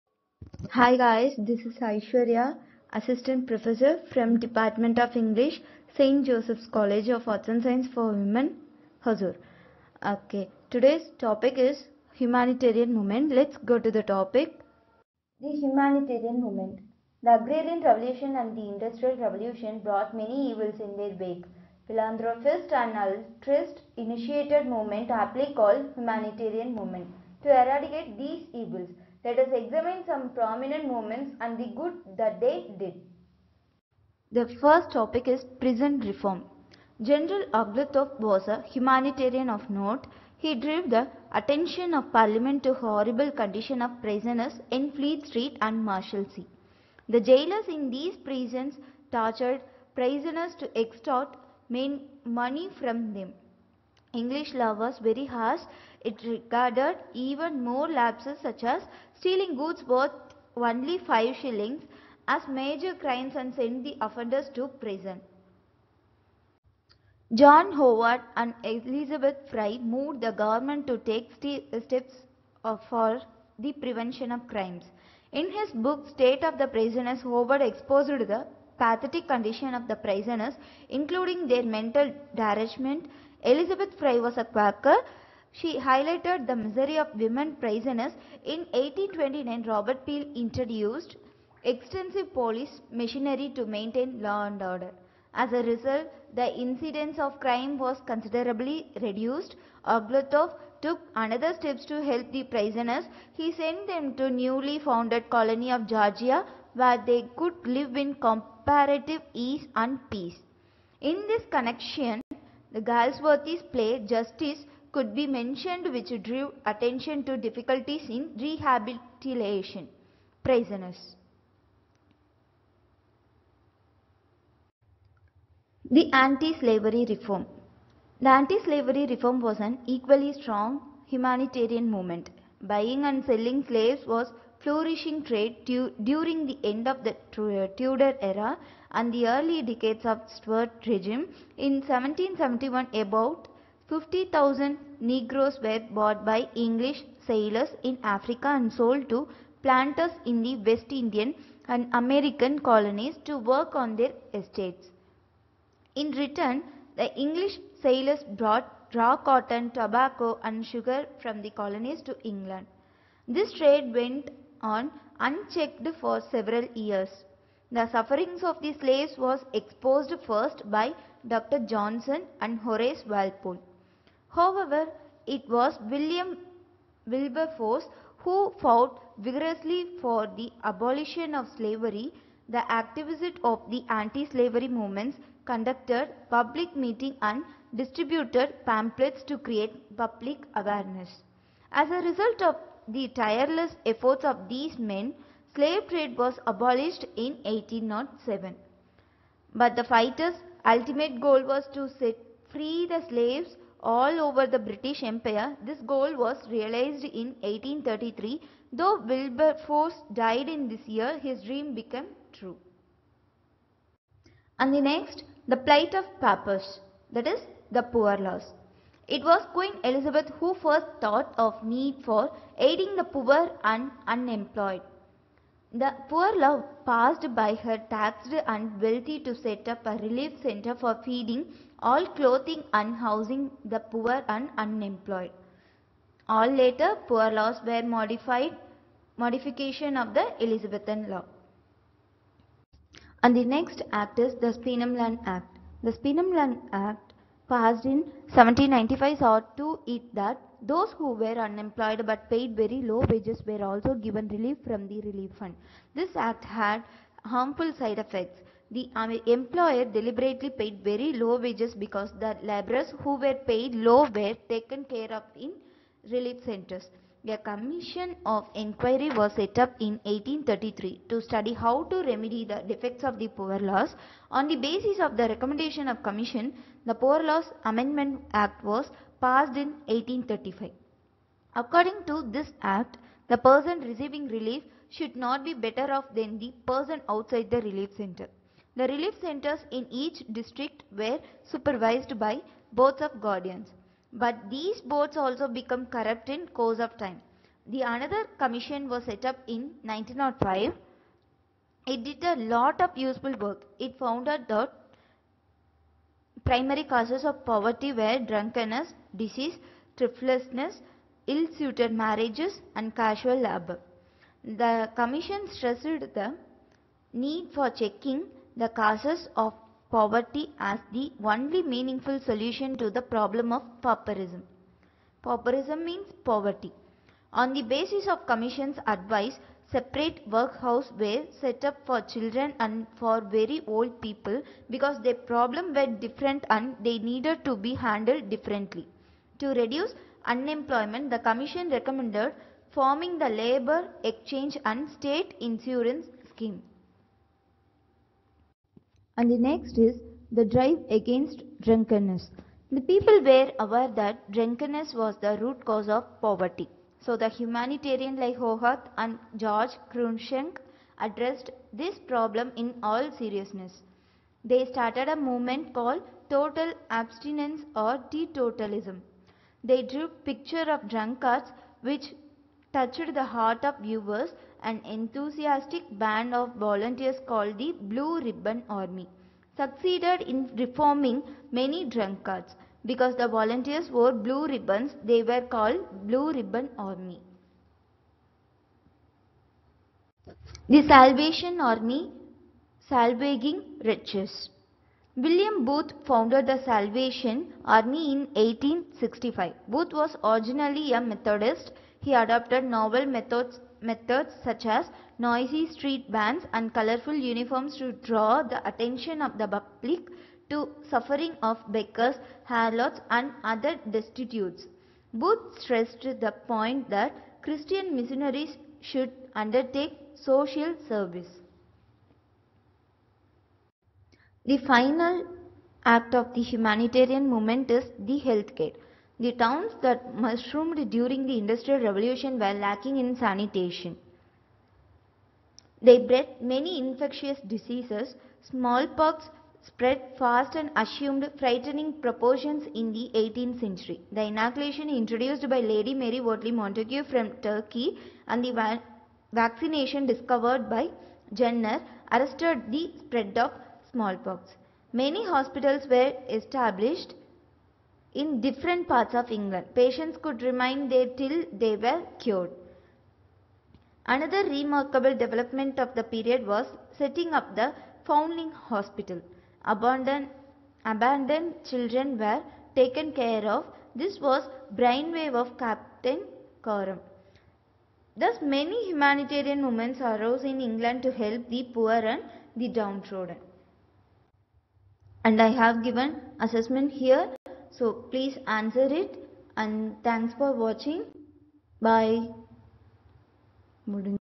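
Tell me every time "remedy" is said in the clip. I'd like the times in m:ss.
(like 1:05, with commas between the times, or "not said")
4:32.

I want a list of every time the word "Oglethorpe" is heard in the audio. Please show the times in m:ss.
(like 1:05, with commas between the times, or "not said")
0:37, 1:39.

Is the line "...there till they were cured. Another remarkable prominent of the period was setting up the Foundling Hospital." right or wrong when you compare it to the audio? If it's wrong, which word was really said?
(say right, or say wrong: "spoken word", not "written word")
wrong: "development", not "prominent".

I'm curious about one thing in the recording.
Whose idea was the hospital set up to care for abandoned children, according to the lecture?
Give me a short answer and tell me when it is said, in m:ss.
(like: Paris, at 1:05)
Captain Coram, at 7:55.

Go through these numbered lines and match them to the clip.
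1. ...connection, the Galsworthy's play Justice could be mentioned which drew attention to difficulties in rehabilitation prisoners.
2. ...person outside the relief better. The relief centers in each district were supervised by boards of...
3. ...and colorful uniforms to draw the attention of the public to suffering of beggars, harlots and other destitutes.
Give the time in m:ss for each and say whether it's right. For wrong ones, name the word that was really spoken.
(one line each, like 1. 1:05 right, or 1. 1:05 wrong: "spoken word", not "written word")
1. 1:51 right
2. 4:46 wrong: "center", not "better"
3. 6:46 right.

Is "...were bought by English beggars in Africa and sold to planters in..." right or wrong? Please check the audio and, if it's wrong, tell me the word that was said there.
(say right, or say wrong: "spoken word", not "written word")
wrong: "sailors", not "beggars".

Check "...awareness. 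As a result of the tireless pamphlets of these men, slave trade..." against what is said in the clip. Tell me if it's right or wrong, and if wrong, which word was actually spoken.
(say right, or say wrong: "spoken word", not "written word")
wrong: "efforts", not "pamphlets".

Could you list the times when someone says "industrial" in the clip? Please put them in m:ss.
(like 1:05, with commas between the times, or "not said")
0:18, 7:11.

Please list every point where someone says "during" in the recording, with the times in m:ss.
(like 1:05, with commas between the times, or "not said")
2:15, 7:10.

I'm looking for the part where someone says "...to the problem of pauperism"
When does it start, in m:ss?
5:22.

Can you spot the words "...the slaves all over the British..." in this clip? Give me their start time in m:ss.
3:22.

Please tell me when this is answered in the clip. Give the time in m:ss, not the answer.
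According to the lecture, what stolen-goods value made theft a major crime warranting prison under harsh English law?
1:00.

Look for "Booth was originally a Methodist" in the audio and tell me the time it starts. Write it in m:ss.
6:39.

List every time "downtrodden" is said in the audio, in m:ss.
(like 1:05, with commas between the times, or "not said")
8:02.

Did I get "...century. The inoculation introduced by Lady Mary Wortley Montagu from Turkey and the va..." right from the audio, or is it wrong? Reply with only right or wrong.
right.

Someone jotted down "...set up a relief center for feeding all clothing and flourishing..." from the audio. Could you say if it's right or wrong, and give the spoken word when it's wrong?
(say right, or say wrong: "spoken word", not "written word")
wrong: "housing", not "flourishing".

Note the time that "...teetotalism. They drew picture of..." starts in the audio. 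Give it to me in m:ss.
6:08.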